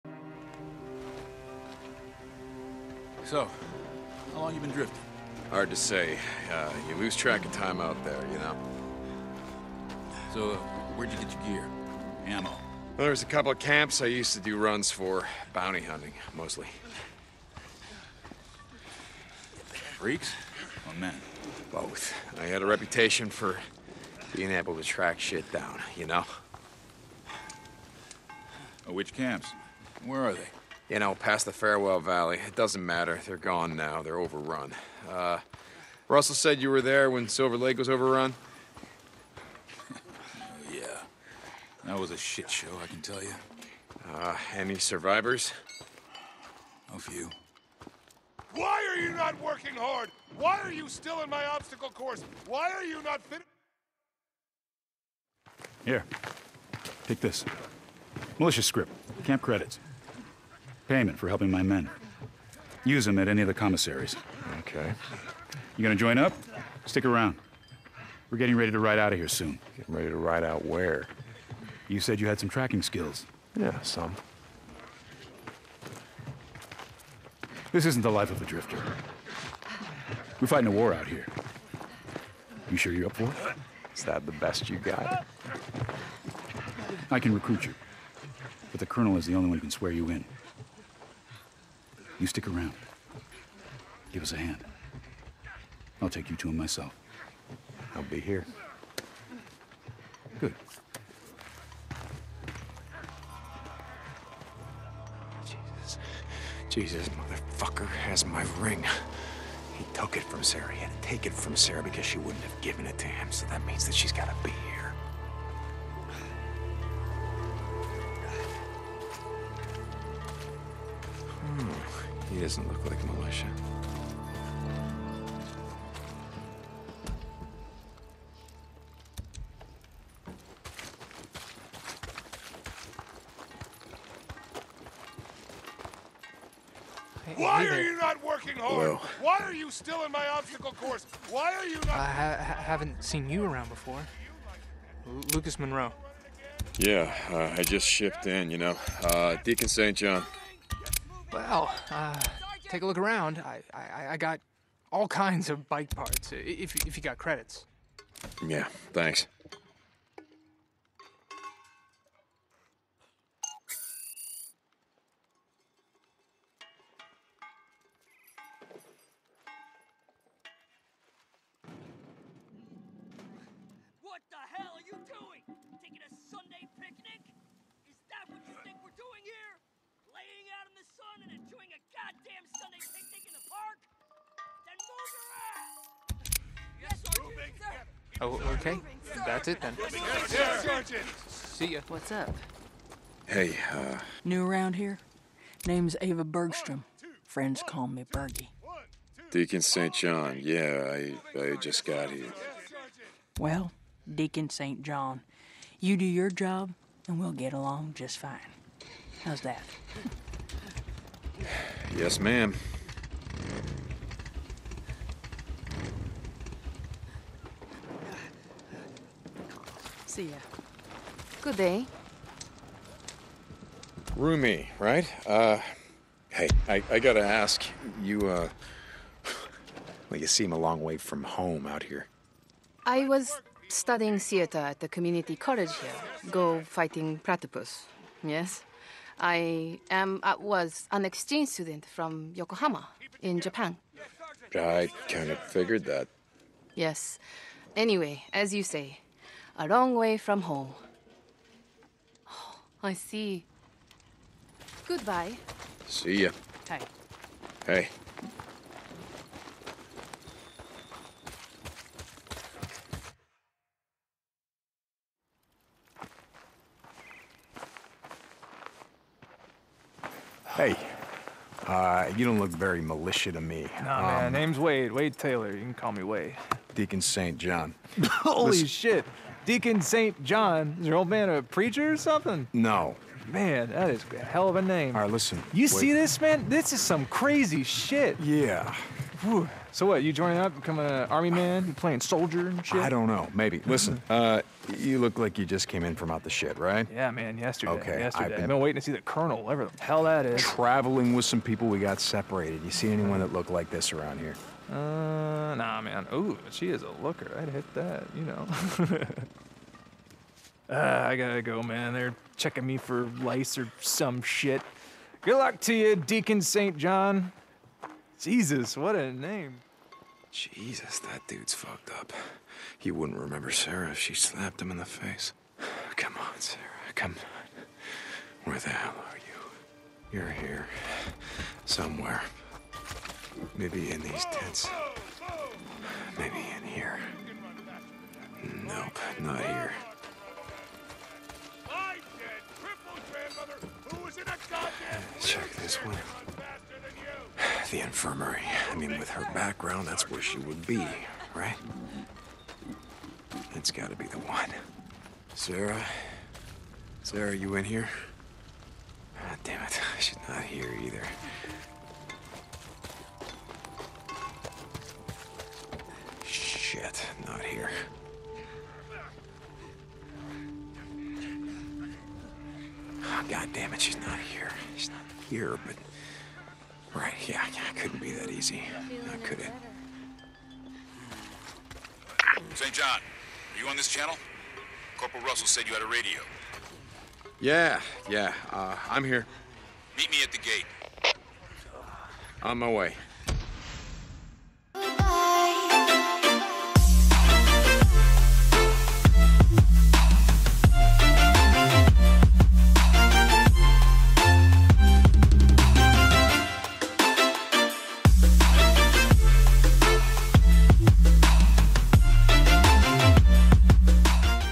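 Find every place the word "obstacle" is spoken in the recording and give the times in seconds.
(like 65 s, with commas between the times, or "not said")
51 s, 140 s.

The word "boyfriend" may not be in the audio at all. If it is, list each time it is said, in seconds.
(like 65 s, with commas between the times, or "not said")
not said.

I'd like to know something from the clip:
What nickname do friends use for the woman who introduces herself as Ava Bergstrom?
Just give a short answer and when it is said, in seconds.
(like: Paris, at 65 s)
Bergie, at 198 s.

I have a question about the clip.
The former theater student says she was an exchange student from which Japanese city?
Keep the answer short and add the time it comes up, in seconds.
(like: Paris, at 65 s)
Yokohama, at 242 s.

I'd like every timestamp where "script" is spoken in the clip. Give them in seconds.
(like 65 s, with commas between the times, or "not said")
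58 s.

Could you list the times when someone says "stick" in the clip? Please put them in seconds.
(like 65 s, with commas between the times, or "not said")
66 s, 92 s.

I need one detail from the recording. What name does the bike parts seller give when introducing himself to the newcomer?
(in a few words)
Lucas Monroe.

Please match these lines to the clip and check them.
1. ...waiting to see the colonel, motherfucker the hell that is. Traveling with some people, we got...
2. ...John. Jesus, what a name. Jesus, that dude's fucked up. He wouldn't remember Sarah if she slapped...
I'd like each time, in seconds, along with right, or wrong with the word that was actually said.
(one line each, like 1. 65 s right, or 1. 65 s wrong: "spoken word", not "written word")
1. 298 s wrong: "whatever", not "motherfucker"
2. 316 s right.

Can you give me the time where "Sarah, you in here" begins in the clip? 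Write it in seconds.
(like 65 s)
357 s.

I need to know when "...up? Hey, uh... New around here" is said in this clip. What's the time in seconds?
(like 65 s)
192 s.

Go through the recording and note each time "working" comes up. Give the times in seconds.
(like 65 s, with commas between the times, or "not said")
49 s, 138 s.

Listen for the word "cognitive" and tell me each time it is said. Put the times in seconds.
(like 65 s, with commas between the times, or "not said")
not said.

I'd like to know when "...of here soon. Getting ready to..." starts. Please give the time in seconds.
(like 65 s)
69 s.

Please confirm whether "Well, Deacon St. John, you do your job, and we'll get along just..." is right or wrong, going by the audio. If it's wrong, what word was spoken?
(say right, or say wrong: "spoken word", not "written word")
right.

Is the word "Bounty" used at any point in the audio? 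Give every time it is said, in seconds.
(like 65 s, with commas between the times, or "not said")
15 s.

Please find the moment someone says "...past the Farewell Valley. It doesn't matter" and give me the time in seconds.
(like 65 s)
31 s.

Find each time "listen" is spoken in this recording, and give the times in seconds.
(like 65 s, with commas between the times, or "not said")
278 s, 285 s, 293 s.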